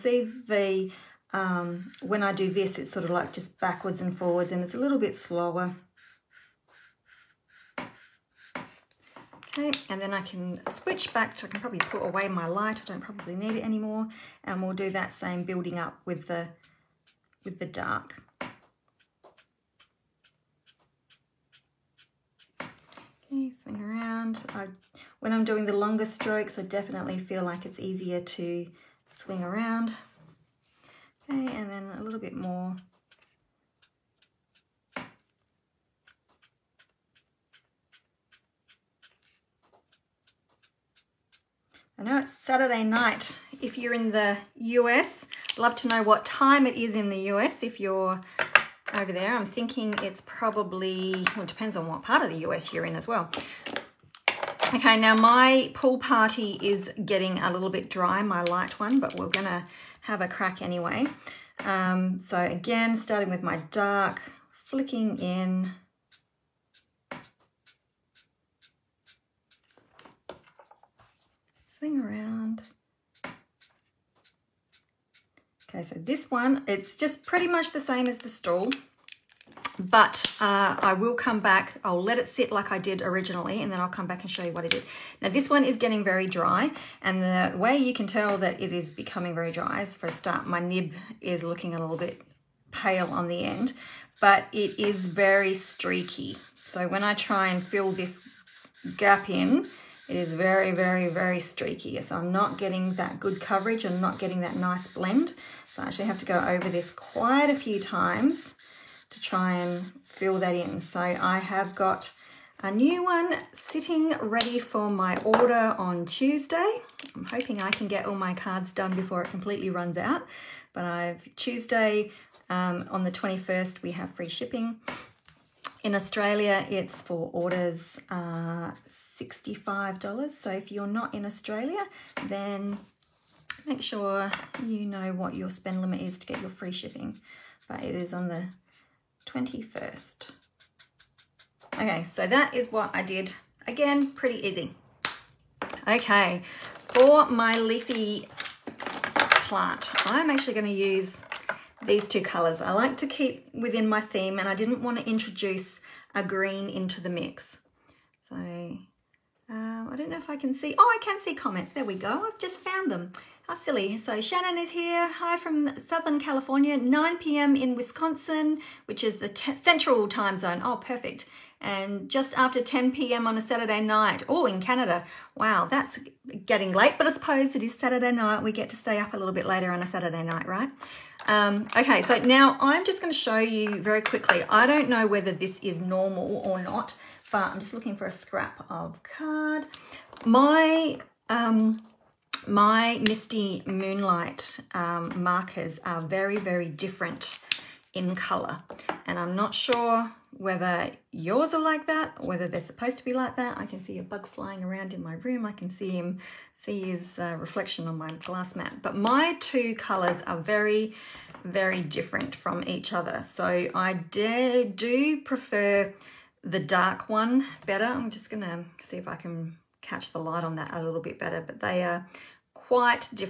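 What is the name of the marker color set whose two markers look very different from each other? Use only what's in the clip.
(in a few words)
Misty Moonlight.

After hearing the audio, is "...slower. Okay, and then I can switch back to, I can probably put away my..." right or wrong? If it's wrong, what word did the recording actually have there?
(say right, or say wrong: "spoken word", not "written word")
right.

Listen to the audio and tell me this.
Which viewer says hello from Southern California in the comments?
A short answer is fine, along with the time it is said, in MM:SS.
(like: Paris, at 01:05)
Shannon, at 02:44.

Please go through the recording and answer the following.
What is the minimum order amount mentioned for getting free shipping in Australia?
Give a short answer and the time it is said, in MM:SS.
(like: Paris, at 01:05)
$65, at 02:09.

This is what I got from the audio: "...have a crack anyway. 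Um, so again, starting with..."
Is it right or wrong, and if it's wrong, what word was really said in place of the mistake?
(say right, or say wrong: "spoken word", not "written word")
right.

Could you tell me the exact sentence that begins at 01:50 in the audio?
So I have got a new one sitting ready for my order on Tuesday.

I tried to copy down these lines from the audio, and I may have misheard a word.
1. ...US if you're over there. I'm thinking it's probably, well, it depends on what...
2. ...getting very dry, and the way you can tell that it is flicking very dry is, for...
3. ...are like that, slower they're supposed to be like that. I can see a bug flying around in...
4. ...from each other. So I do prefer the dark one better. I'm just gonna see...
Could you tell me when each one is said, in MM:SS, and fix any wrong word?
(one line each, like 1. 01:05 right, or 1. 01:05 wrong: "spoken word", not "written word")
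1. 00:47 right
2. 01:25 wrong: "becoming", not "flicking"
3. 03:21 wrong: "whether", not "slower"
4. 03:32 right.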